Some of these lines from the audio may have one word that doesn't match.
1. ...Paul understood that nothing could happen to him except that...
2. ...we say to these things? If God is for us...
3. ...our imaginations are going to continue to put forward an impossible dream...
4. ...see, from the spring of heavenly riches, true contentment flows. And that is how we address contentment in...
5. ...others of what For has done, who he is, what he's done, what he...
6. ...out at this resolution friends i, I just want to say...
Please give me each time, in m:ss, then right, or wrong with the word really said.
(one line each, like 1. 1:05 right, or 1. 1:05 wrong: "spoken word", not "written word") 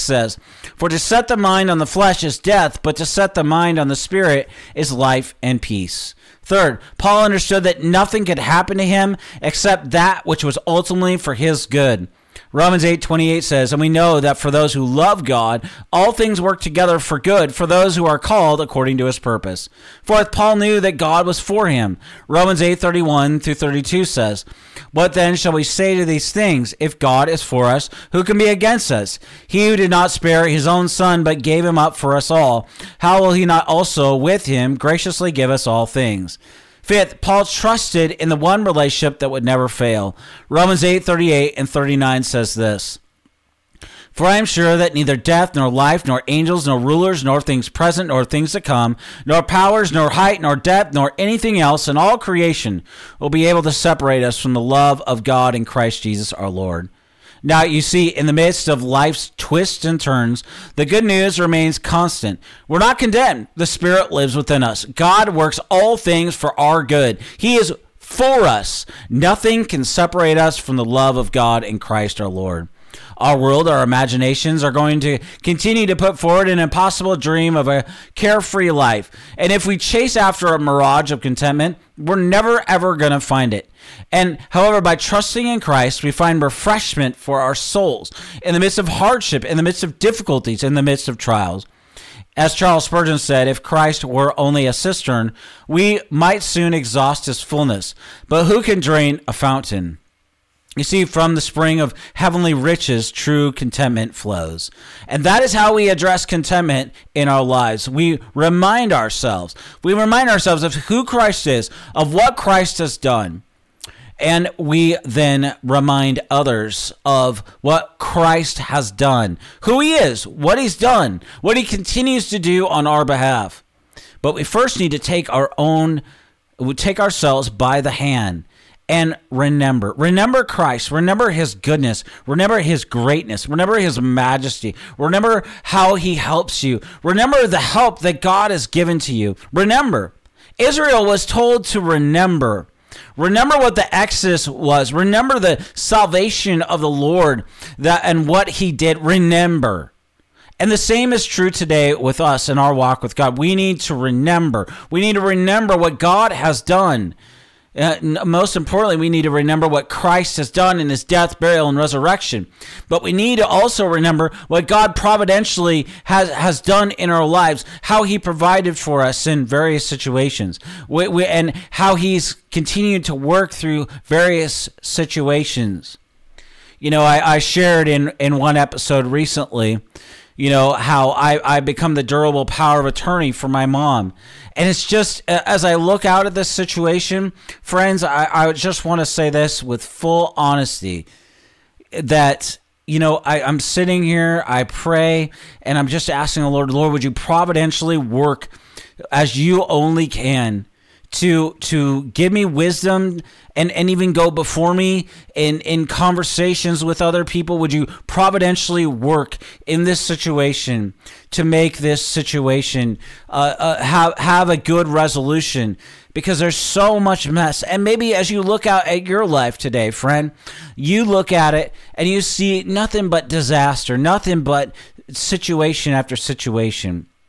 1. 0:06 right
2. 0:25 right
3. 1:13 right
4. 1:40 right
5. 1:56 wrong: "Christ", not "For"
6. 3:06 wrong: "situation", not "resolution".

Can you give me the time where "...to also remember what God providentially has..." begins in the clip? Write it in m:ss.
2:43.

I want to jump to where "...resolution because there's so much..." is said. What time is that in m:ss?
3:34.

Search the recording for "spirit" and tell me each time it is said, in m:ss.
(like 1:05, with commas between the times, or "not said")
0:03, 1:03.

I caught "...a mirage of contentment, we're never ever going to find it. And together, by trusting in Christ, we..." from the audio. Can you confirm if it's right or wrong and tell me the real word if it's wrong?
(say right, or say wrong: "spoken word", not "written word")
wrong: "however", not "together".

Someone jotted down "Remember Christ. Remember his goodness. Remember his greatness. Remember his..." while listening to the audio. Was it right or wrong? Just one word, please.
right.